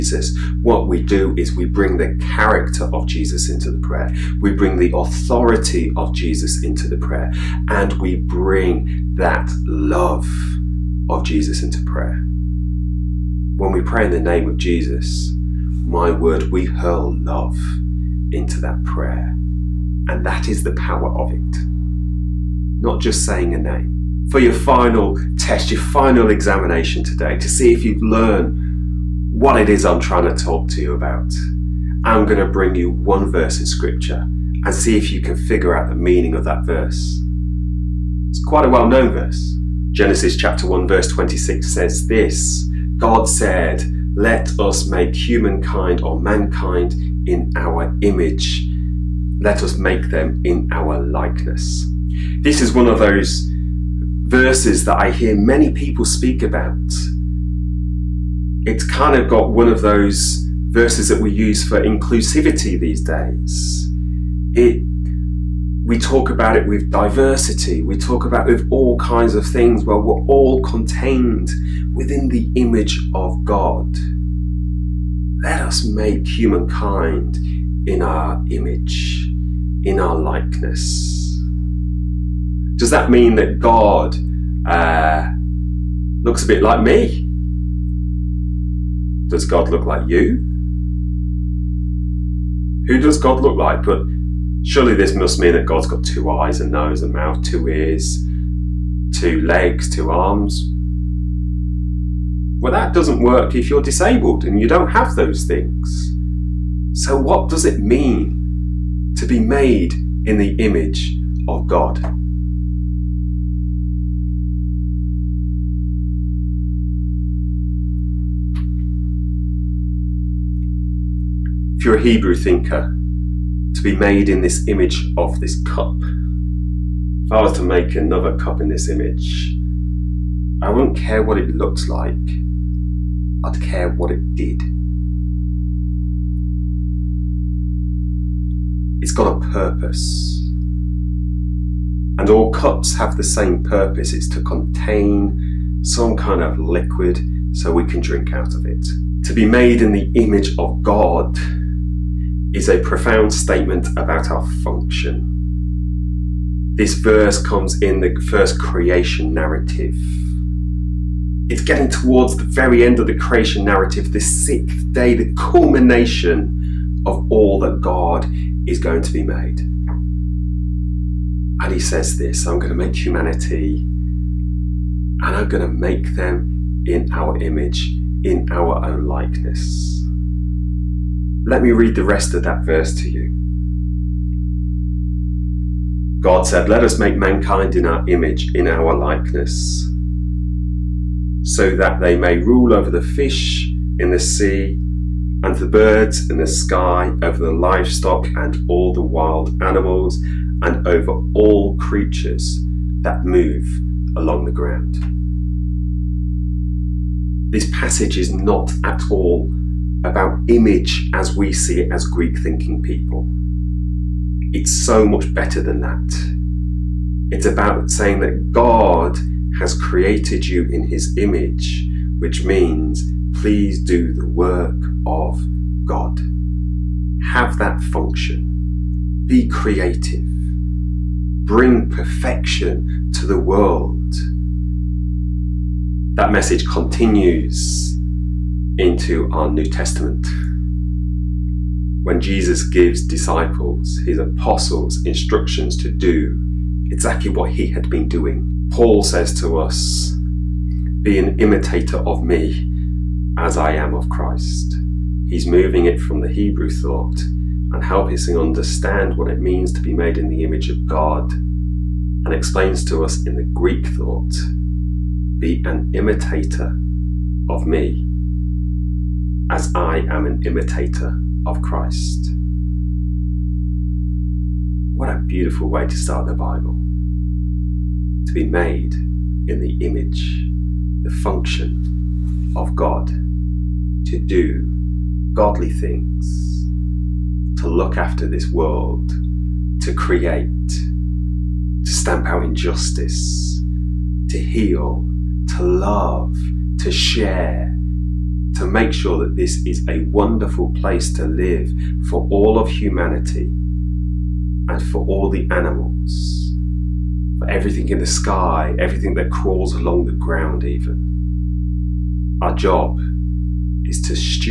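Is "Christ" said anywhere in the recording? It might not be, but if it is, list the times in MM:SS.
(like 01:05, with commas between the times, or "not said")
04:14, 04:31.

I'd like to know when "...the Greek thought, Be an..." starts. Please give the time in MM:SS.
04:23.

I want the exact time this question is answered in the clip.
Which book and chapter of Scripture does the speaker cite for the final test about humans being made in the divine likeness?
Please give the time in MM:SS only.
00:39.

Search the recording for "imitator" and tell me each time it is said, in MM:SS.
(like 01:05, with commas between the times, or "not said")
04:11, 04:25, 04:30.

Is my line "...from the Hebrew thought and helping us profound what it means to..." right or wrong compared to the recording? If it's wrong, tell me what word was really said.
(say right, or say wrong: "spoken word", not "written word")
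wrong: "understand", not "profound".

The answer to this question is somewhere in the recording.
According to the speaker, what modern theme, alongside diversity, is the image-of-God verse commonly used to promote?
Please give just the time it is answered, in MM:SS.
01:01.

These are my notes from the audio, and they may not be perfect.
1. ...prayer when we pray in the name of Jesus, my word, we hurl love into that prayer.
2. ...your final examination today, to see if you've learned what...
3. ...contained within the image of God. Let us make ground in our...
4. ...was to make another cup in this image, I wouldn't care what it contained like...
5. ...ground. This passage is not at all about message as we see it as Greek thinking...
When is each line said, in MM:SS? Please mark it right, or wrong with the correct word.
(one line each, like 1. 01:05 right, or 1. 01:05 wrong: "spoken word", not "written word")
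1. 00:11 right
2. 00:25 right
3. 01:10 wrong: "humankind", not "ground"
4. 02:07 wrong: "looked", not "contained"
5. 03:24 wrong: "image", not "message".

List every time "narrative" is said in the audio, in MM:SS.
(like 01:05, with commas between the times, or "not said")
02:39, 02:43.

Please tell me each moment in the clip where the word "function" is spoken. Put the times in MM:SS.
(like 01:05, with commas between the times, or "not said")
02:34, 03:47, 04:41.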